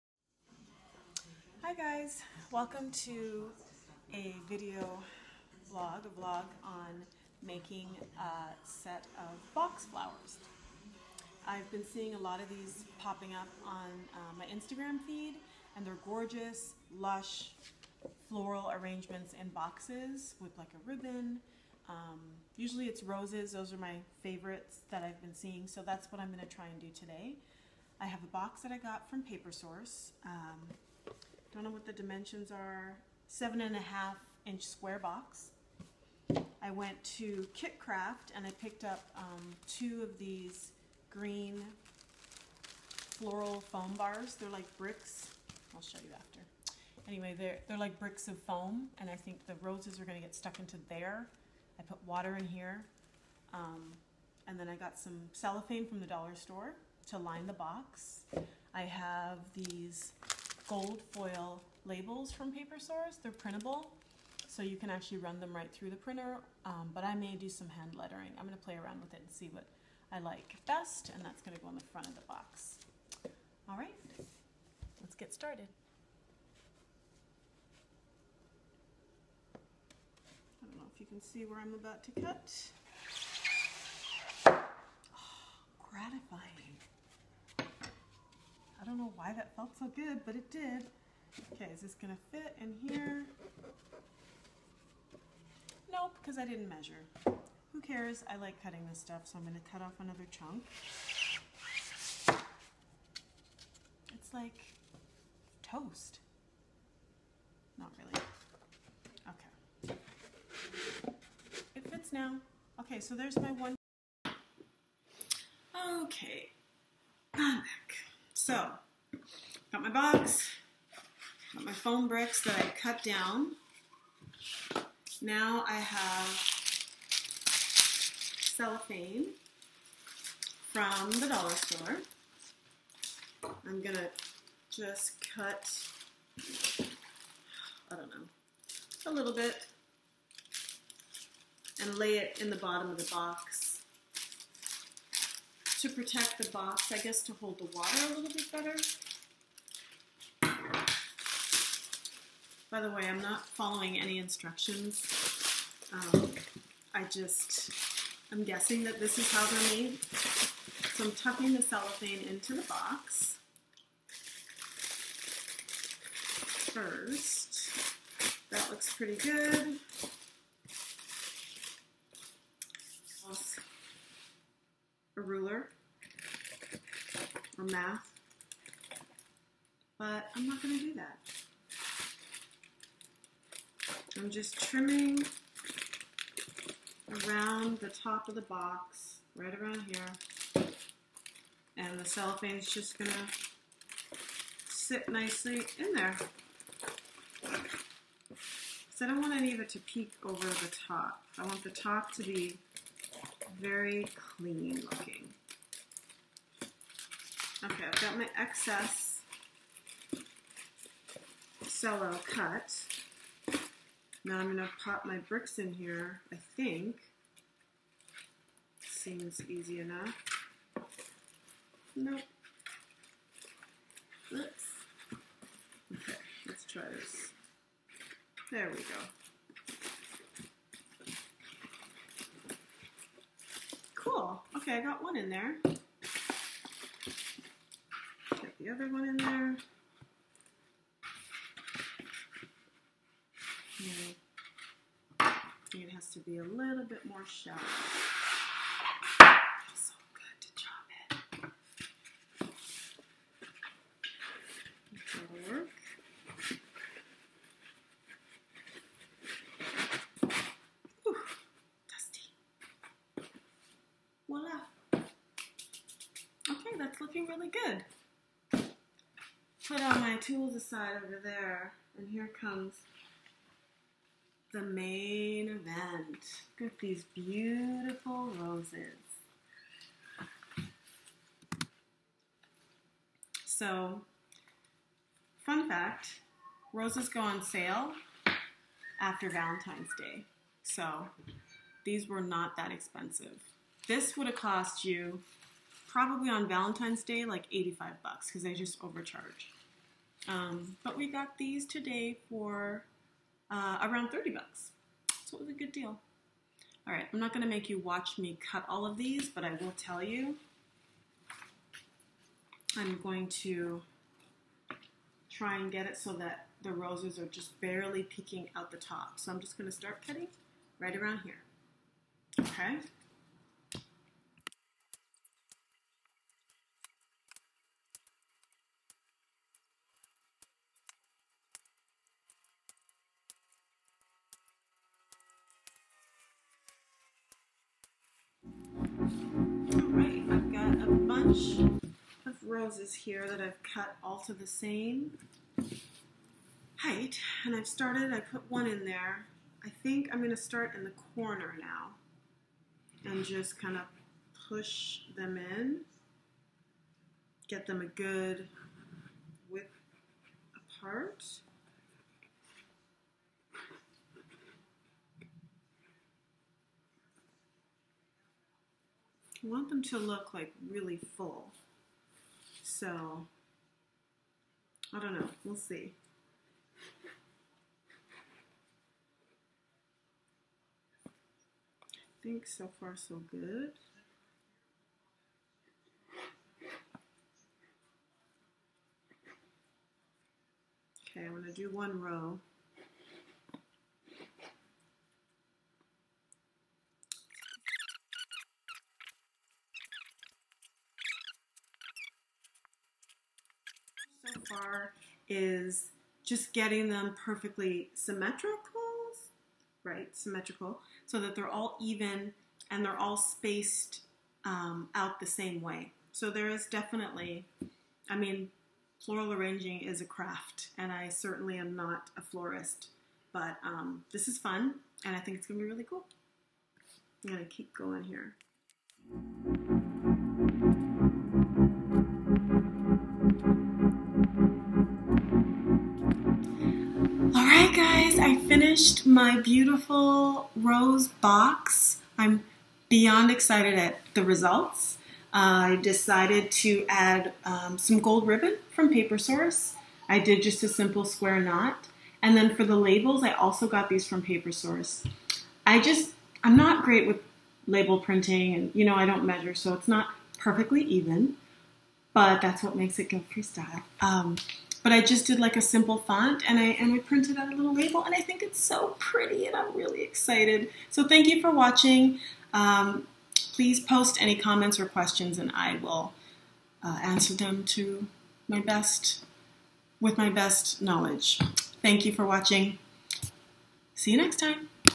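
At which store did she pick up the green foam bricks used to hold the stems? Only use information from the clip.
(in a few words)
Kit Kraft.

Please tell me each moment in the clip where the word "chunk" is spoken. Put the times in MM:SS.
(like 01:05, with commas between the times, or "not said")
01:40.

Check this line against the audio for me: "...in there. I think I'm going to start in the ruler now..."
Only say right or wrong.
wrong.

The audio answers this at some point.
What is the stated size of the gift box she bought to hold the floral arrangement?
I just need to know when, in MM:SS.
00:33.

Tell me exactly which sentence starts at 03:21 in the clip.
I want the top to be very clean looking.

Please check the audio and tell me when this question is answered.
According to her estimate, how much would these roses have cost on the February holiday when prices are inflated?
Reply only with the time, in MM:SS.
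04:57.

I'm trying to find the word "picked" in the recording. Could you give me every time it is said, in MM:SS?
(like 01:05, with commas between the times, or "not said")
00:38.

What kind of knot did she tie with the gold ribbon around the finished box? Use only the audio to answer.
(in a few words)
square knot.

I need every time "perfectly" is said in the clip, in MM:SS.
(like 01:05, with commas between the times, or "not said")
06:47, 07:40.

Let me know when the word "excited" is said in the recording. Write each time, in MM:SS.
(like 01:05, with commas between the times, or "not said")
07:23, 07:50.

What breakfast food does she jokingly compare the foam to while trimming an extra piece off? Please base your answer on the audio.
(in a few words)
toast.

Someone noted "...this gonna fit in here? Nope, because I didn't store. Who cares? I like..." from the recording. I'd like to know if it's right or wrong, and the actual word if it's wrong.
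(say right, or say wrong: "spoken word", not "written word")
wrong: "measure", not "store".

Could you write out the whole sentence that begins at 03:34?
Now I'm gonna pop my bricks in here, I think.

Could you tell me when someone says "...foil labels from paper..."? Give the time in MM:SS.
01:01.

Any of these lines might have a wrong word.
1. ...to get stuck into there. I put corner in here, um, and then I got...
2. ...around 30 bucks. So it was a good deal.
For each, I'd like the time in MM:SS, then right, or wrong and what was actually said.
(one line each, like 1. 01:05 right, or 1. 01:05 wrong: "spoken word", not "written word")
1. 00:50 wrong: "water", not "corner"
2. 05:03 right.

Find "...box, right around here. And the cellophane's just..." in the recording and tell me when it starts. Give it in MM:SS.
03:08.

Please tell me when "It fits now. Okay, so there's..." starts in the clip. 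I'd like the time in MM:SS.
01:51.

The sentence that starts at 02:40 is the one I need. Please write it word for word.
So I'm tucking the cellophane into the box first.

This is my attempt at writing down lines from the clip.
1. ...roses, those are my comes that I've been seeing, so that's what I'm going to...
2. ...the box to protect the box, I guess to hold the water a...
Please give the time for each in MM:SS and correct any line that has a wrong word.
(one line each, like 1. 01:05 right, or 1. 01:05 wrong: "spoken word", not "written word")
1. 00:23 wrong: "favorites", not "comes"
2. 02:22 right.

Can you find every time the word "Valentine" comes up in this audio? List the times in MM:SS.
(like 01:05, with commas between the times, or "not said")
04:49, 04:56.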